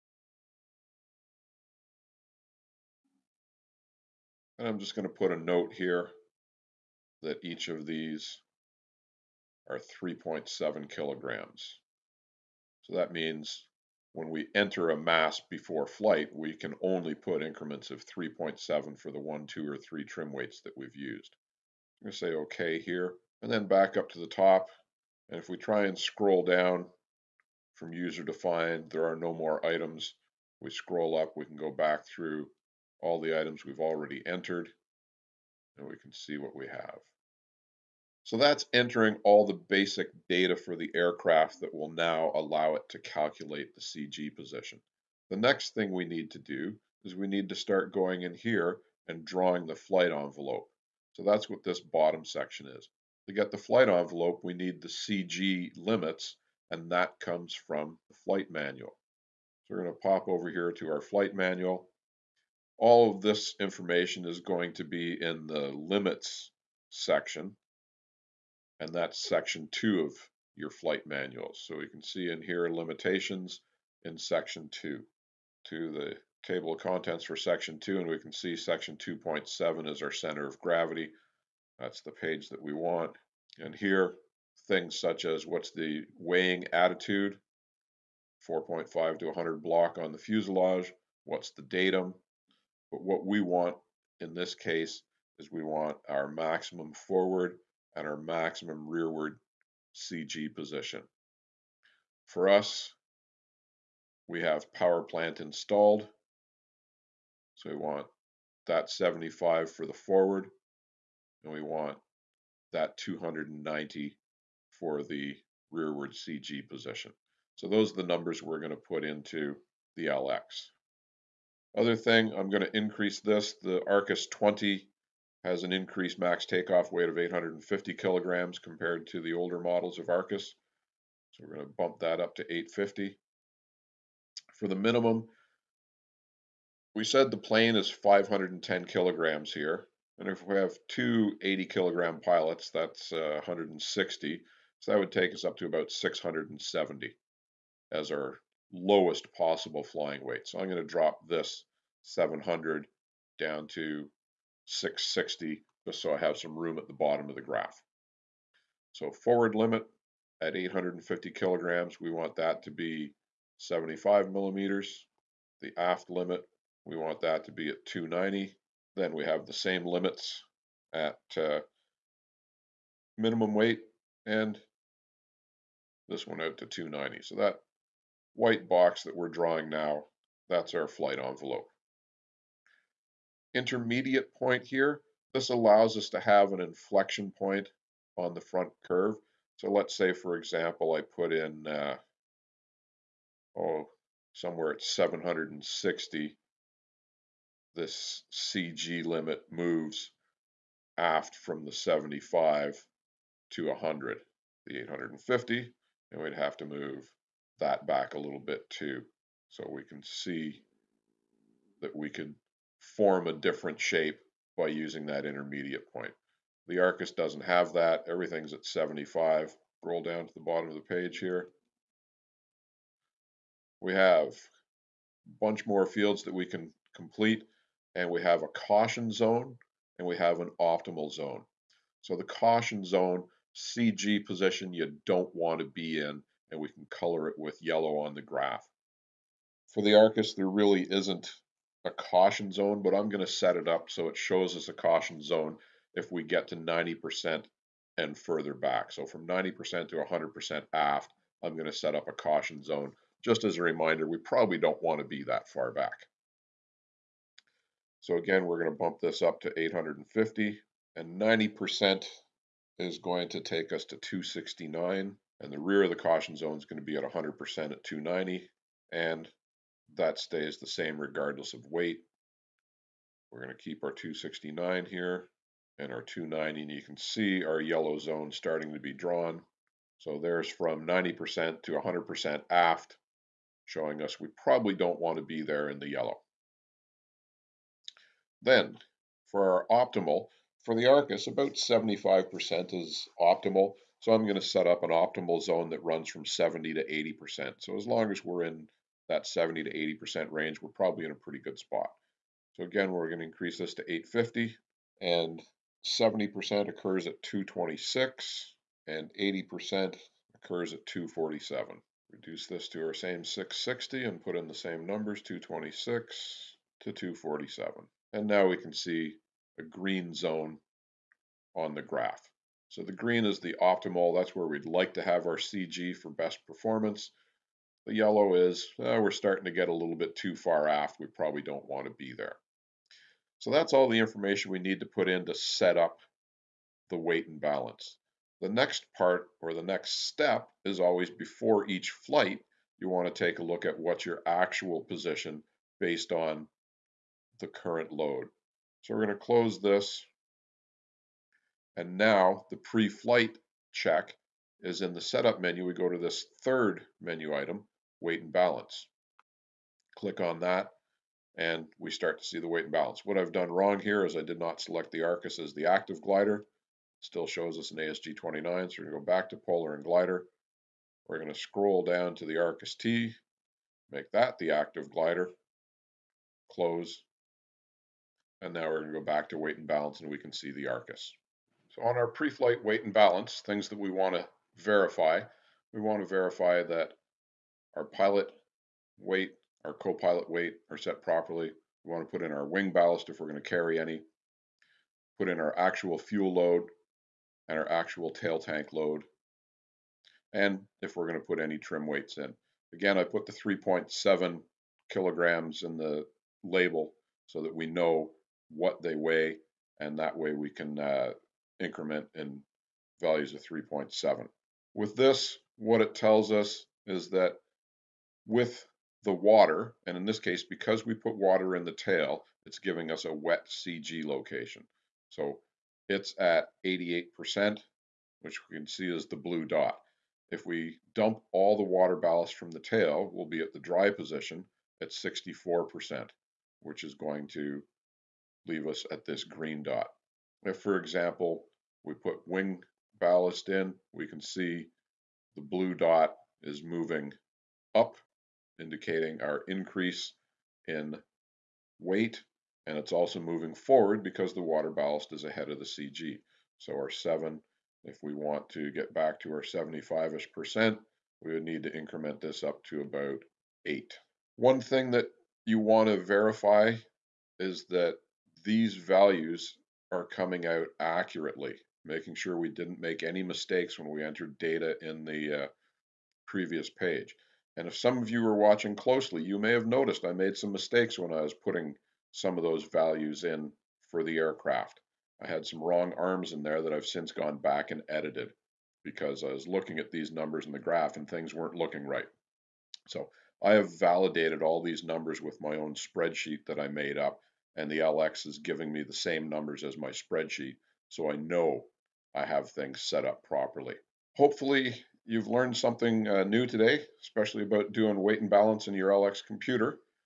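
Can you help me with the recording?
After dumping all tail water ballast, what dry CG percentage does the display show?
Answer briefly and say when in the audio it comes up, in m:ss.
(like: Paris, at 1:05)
64%, at 7:14.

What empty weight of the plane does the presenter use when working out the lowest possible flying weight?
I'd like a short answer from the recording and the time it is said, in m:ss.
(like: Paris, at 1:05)
510 kg, at 2:17.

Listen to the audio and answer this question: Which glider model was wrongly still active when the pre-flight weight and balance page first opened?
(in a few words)
ASG 29.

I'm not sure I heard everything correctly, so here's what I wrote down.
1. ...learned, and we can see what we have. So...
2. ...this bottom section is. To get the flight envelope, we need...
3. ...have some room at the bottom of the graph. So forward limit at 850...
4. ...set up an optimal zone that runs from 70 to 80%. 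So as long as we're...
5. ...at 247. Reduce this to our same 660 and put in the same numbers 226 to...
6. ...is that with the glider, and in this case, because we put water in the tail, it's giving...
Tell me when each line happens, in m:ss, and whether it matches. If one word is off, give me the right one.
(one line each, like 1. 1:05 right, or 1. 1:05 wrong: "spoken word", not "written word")
1. 0:34 wrong: "entered", not "learned"
2. 0:51 right
3. 2:36 right
4. 4:54 right
5. 5:10 right
6. 6:56 wrong: "water", not "glider".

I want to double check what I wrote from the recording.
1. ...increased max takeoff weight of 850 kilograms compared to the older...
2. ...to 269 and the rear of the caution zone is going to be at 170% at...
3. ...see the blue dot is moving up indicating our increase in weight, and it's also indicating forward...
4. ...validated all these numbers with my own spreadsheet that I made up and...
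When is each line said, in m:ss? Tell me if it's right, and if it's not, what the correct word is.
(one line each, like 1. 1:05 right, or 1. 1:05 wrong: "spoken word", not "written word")
1. 2:05 right
2. 4:23 wrong: "100", not "170"
3. 7:24 wrong: "moving", not "indicating"
4. 8:13 right.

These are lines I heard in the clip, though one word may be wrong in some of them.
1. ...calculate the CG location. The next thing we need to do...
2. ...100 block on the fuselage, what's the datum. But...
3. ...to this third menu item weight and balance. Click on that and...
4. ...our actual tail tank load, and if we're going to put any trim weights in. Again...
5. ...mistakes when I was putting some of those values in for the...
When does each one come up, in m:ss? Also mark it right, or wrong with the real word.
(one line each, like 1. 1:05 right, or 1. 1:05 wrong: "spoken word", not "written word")
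1. 0:42 wrong: "position", not "location"
2. 1:29 right
3. 5:55 right
4. 6:37 right
5. 8:00 right.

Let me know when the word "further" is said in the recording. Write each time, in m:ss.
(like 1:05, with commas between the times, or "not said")
4:08.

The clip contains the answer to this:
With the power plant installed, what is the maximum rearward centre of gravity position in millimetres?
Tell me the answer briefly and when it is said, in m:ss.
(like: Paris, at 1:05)
290, at 1:52.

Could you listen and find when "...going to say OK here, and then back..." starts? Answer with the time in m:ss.
0:22.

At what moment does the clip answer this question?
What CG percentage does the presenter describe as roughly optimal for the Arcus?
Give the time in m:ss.
4:51.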